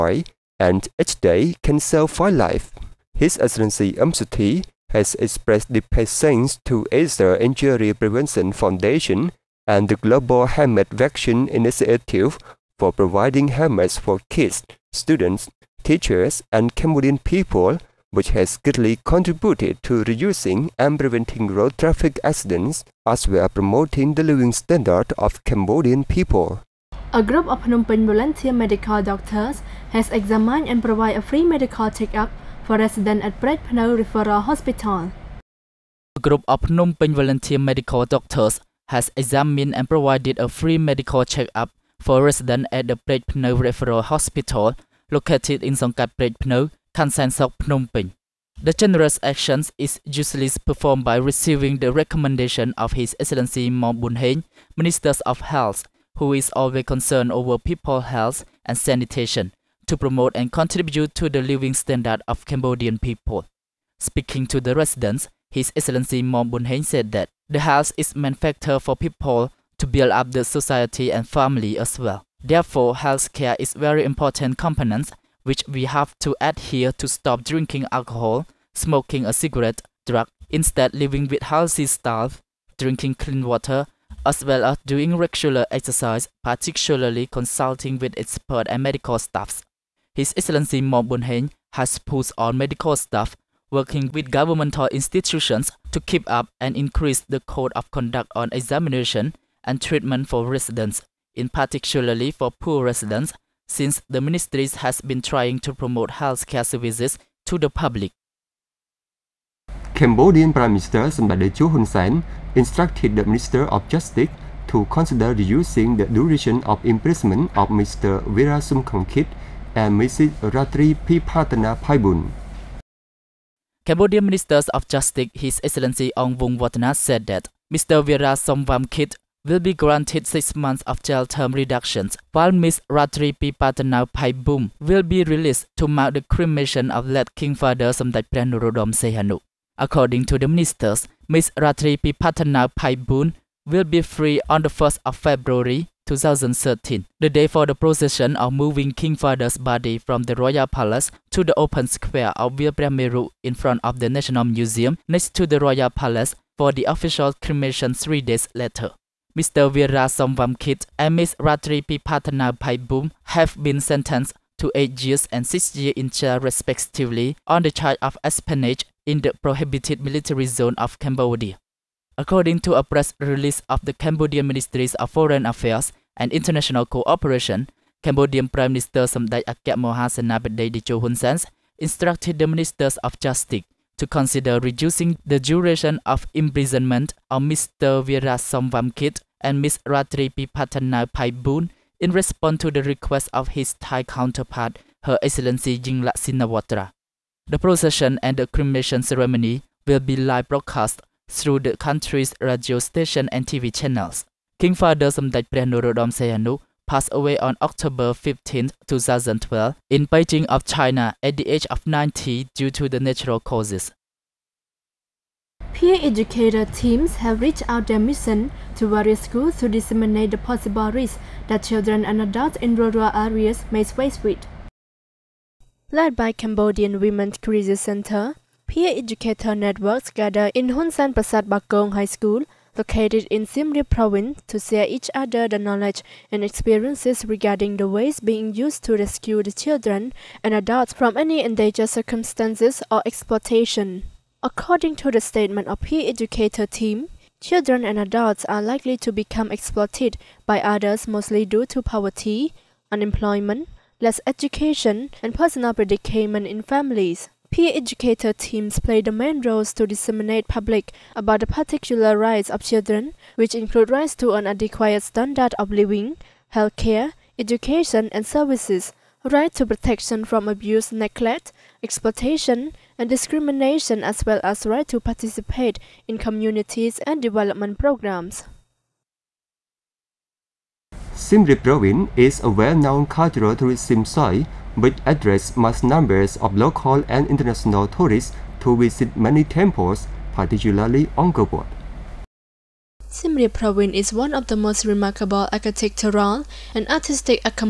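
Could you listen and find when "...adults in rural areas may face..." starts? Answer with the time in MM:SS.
03:42.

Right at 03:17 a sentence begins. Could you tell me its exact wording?
The procession and the cremation ceremony will be live broadcast through the country's radio station and TV channels.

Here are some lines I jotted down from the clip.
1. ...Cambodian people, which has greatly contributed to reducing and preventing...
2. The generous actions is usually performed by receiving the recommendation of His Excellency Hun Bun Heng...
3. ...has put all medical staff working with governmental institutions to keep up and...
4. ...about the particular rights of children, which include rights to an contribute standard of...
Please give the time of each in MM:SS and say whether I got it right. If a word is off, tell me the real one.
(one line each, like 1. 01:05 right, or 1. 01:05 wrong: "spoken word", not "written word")
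1. 00:16 right
2. 00:48 wrong: "Mam", not "Hun"
3. 01:31 right
4. 04:21 wrong: "adequate", not "contribute".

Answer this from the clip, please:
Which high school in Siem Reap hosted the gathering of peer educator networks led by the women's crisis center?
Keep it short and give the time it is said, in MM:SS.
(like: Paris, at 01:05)
Hunsan Prasad Bakong High School, at 03:50.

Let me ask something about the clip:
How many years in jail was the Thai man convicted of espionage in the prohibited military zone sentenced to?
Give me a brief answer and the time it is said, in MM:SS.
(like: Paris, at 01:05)
8 years, at 02:44.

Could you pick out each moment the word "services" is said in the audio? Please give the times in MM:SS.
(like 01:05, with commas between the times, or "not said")
01:46, 04:28.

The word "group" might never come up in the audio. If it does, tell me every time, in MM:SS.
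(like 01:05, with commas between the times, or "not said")
00:27, 00:36.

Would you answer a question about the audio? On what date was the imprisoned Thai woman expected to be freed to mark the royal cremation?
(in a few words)
1 February 2013.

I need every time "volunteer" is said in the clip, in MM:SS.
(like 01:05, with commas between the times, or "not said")
00:28, 00:37.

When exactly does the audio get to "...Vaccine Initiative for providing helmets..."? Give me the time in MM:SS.
00:10.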